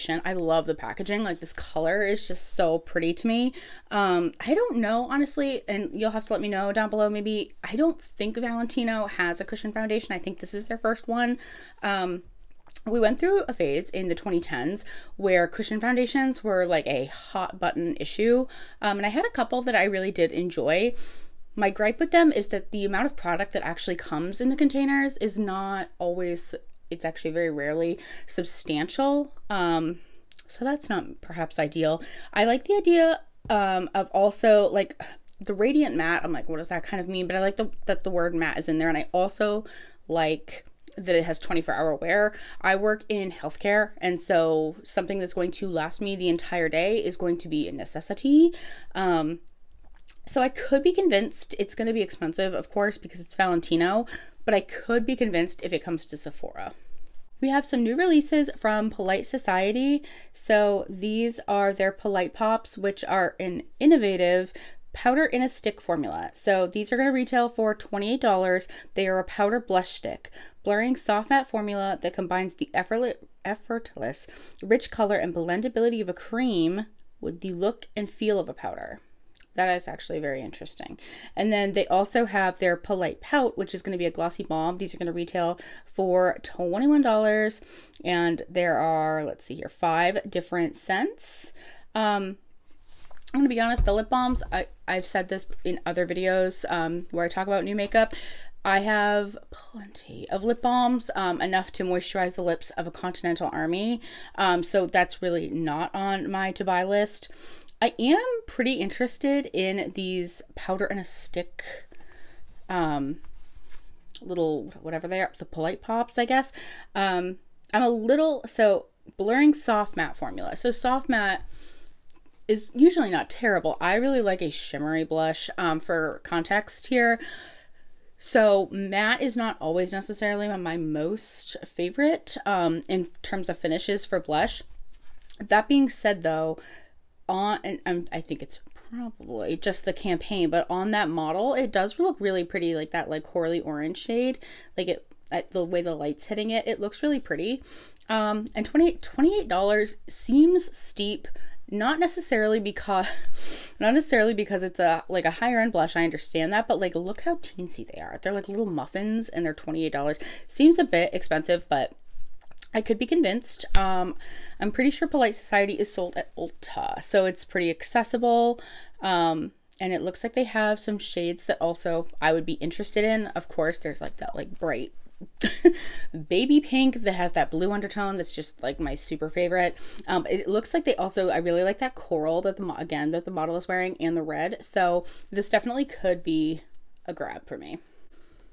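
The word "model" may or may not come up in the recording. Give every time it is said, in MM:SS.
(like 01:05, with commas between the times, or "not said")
02:21, 03:03.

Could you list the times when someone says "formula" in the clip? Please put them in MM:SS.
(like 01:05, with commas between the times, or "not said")
01:05, 01:11, 02:00.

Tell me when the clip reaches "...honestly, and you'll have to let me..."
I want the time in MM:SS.
00:05.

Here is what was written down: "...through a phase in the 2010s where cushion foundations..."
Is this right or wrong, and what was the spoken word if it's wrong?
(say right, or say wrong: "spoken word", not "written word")
right.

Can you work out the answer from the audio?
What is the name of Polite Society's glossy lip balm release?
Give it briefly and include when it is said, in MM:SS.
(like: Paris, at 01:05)
Polite Pout, at 01:22.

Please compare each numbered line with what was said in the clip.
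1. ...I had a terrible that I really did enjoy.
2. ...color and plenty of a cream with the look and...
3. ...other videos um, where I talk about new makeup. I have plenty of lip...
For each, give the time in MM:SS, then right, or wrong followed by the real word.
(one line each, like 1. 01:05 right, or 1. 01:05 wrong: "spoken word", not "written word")
1. 00:19 wrong: "couple", not "terrible"
2. 01:14 wrong: "blendability", not "plenty"
3. 01:35 right.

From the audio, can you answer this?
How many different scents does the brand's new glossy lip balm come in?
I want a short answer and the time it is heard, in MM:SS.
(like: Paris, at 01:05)
5, at 01:29.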